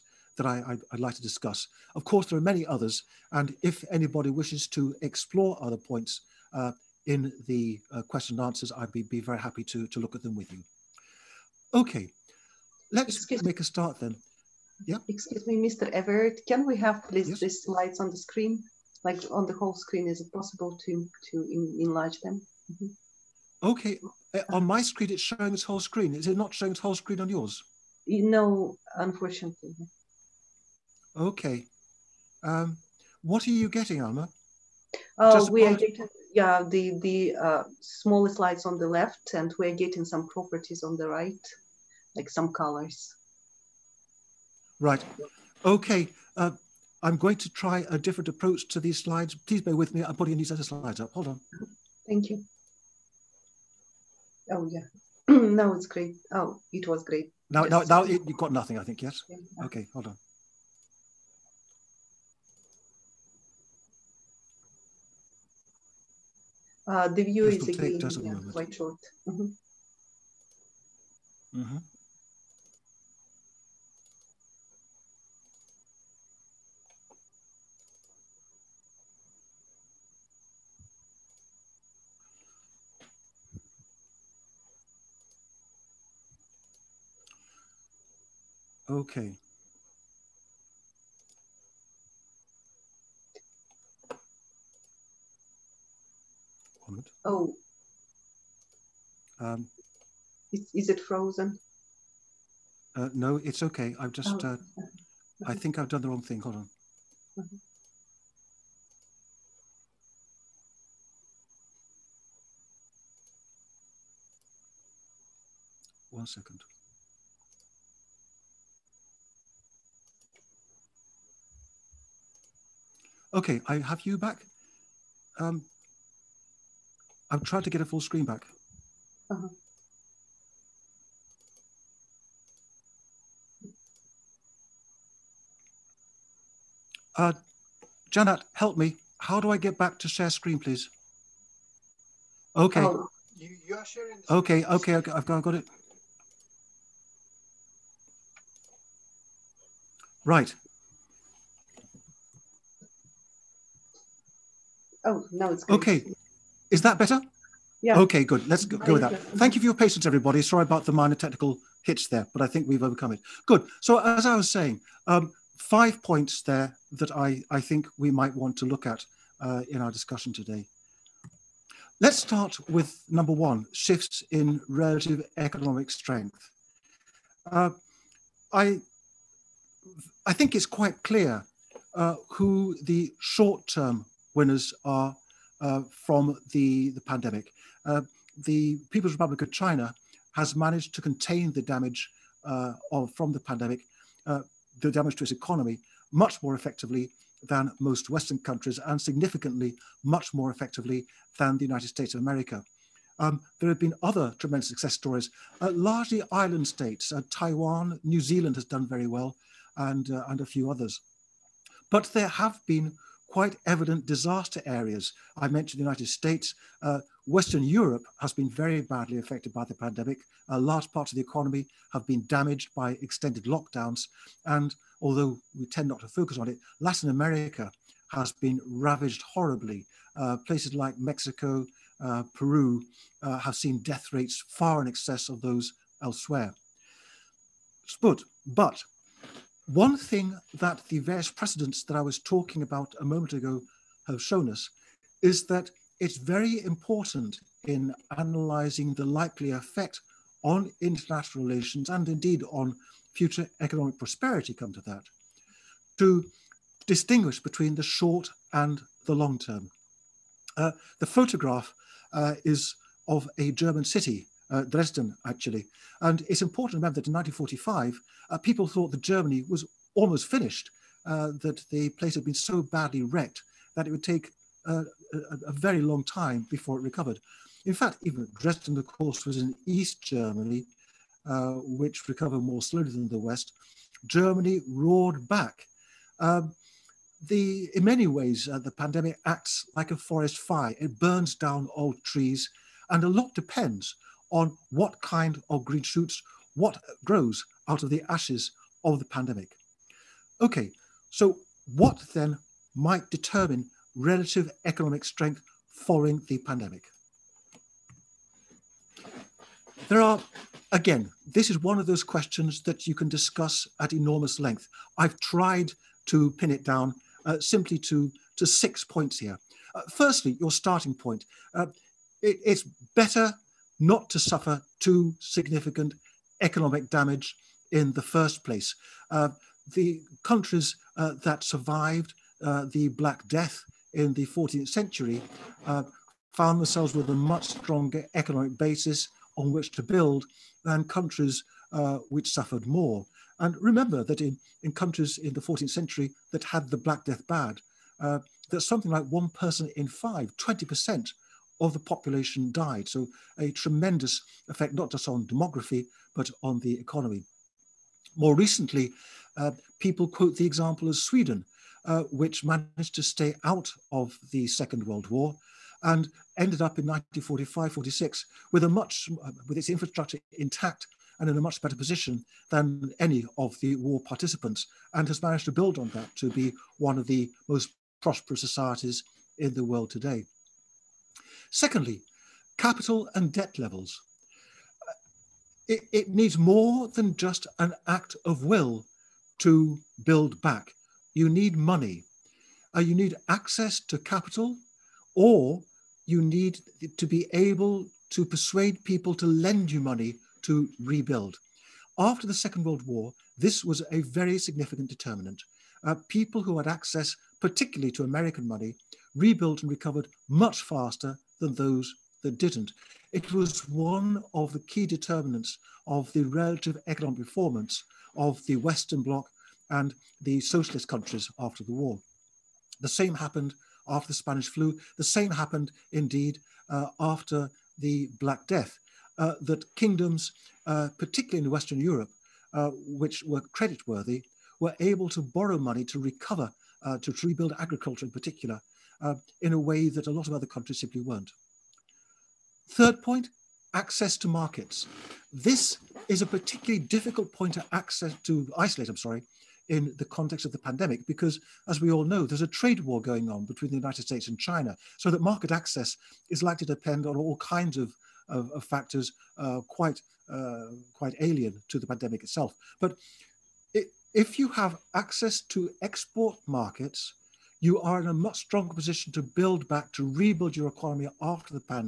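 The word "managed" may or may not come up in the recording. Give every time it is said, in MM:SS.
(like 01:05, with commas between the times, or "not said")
03:10, 06:02, 06:15.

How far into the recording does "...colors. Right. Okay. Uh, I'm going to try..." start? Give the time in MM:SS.
00:42.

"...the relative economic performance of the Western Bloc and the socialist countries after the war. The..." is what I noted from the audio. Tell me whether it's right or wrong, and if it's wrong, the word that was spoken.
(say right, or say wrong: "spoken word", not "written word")
right.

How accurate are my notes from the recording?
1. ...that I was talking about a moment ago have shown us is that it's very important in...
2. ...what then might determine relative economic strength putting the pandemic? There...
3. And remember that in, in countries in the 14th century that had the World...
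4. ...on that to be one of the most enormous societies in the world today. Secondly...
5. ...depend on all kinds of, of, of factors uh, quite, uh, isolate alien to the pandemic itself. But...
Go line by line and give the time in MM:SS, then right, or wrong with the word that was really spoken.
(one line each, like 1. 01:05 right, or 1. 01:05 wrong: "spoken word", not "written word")
1. 04:01 right
2. 05:01 wrong: "following", not "putting"
3. 05:43 wrong: "Black", not "World"
4. 06:15 wrong: "prosperous", not "enormous"
5. 07:36 wrong: "quite", not "isolate".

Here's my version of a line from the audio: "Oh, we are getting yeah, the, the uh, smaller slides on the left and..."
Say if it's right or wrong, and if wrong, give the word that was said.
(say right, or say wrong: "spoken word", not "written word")
right.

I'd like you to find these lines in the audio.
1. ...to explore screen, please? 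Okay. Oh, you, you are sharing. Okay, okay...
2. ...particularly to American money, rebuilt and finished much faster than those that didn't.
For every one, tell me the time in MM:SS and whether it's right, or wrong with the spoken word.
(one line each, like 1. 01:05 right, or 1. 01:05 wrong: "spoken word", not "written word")
1. 02:19 wrong: "share", not "explore"
2. 06:47 wrong: "recovered", not "finished".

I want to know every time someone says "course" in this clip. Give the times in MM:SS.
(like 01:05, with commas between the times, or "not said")
00:02, 04:38.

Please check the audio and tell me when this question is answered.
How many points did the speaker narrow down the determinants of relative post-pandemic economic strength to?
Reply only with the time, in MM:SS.
05:18.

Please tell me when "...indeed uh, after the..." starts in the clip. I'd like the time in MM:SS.
07:05.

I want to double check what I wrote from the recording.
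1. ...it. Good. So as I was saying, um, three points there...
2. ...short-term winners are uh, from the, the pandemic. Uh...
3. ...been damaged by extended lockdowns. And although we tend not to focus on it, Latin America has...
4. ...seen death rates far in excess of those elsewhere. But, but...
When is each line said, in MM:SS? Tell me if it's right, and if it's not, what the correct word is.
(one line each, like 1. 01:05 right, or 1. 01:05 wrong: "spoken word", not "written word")
1. 02:43 wrong: "five", not "three"
2. 03:03 right
3. 03:42 right
4. 03:53 right.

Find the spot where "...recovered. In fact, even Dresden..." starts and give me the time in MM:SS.
04:36.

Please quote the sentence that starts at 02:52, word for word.
Let's start with number one, shifts in relative economic strength.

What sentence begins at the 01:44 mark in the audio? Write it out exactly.
uh, I think I've done the wrong thing.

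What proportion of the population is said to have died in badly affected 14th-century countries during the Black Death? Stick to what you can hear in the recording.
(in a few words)
20%.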